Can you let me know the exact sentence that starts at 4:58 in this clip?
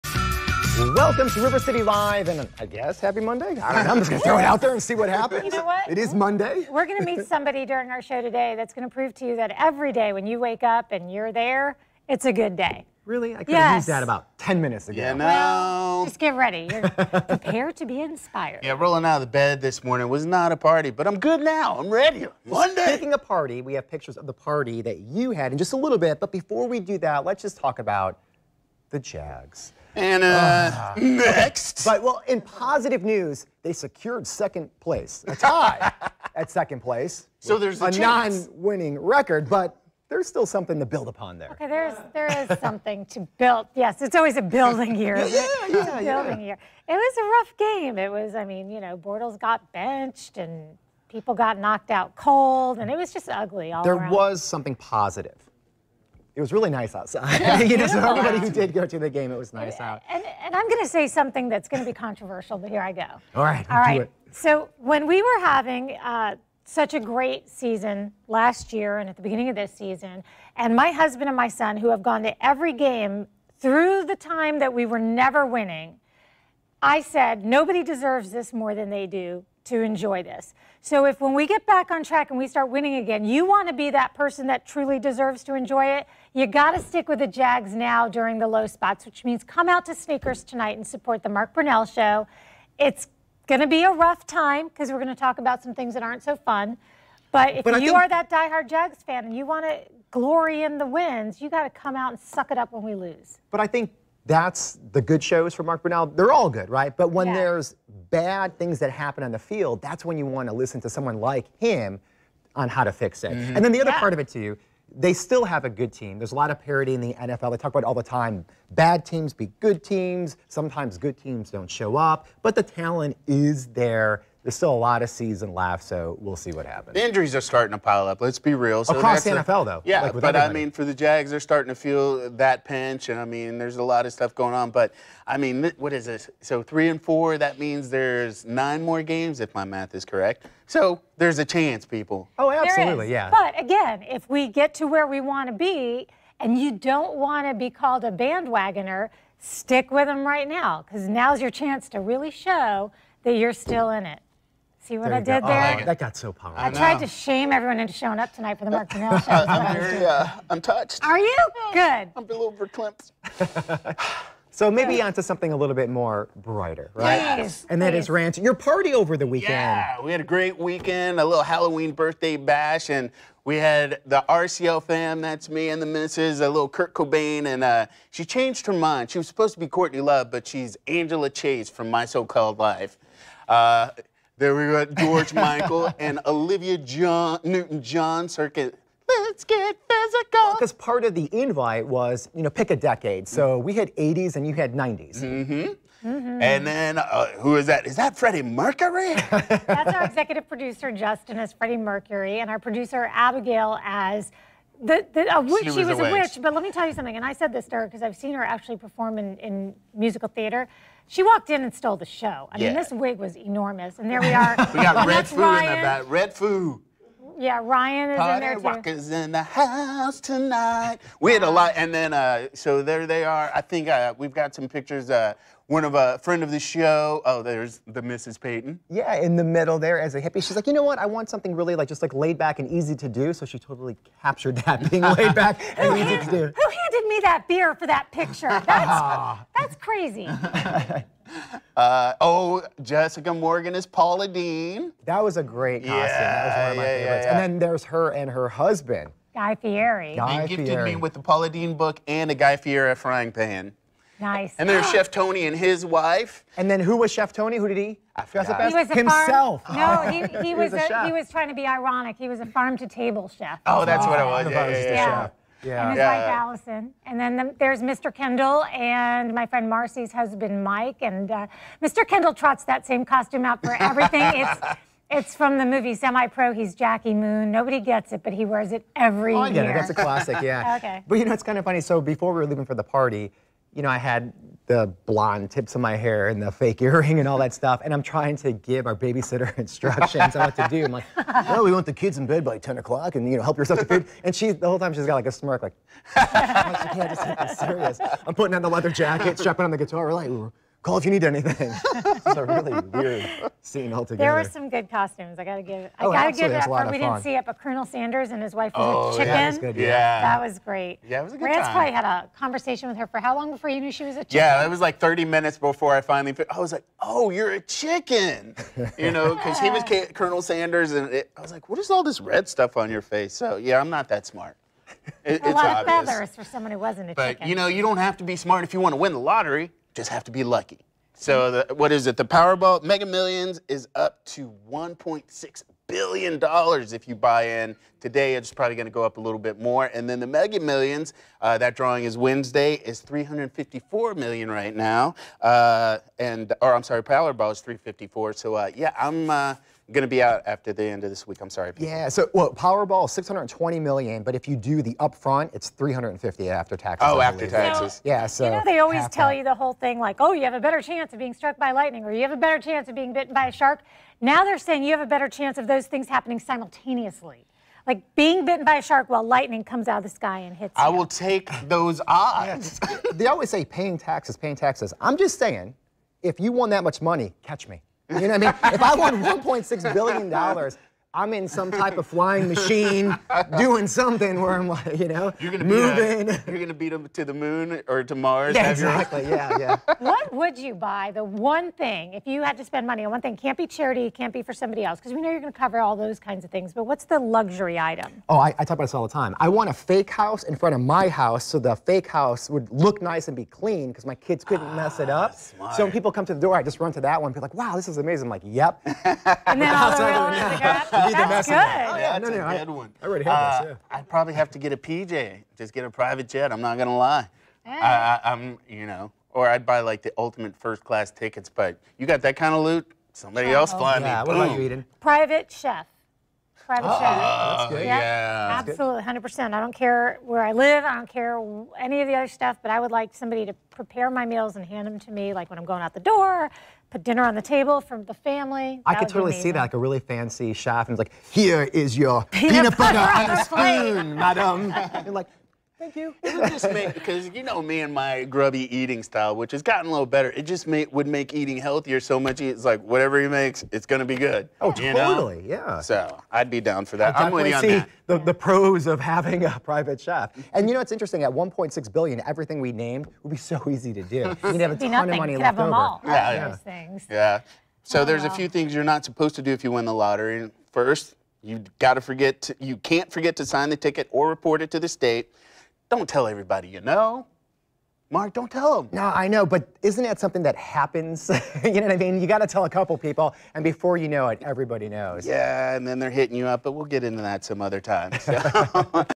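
I'm putting on the leather jacket, strapping on the guitar.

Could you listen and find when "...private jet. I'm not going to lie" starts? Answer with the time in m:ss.
6:55.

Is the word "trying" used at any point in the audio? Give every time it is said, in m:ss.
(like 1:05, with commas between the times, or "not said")
4:21, 4:48.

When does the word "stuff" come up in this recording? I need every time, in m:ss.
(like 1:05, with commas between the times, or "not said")
2:14, 4:47, 5:22, 7:12.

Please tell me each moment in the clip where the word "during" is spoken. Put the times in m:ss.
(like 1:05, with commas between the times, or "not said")
0:07, 1:28.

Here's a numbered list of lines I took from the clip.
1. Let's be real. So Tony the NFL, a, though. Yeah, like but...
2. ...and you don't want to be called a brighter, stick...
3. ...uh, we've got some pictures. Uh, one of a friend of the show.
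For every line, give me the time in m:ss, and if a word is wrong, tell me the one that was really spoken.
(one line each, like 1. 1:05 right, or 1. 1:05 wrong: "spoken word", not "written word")
1. 2:08 wrong: "Across", not "Tony"
2. 2:26 wrong: "bandwagoner", not "brighter"
3. 3:43 right.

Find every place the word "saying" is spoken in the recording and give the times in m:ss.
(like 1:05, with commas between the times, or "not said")
6:04, 6:15.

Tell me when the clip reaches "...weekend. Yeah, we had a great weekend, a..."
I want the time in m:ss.
2:49.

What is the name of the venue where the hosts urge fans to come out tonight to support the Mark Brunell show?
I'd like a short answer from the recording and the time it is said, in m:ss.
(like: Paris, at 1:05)
Sneakers, at 1:29.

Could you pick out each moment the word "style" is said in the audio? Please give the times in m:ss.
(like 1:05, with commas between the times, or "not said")
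7:29.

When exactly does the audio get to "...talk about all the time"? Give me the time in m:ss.
1:57.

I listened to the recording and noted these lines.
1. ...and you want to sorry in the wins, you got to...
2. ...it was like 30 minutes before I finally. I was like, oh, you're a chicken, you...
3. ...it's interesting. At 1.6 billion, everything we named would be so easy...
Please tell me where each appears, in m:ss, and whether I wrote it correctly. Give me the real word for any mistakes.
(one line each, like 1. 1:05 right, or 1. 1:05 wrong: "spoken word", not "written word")
1. 1:39 wrong: "glory", not "sorry"
2. 5:14 right
3. 7:40 right.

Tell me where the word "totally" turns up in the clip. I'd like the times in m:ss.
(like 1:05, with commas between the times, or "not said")
3:53, 7:19, 7:34.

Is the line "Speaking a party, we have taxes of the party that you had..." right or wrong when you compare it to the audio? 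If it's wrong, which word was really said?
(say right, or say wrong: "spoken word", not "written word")
wrong: "pictures", not "taxes".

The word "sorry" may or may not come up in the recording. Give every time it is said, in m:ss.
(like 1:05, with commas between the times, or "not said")
5:46, 5:51.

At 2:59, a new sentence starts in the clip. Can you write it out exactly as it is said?
She was supposed to be Courtney Love, but she's Angela Chase from My So Called Life.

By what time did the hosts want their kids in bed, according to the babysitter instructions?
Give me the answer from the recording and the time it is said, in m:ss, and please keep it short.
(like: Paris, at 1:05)
10 o'clock, at 4:52.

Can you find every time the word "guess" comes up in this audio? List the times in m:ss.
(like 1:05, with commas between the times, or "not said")
0:02.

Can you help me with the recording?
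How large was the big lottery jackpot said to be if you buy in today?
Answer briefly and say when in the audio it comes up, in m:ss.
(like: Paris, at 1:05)
$1.6 billion, at 5:34.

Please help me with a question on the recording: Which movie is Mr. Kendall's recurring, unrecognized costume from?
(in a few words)
Semi Pro.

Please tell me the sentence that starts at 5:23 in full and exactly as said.
So yeah, I'm not that smart.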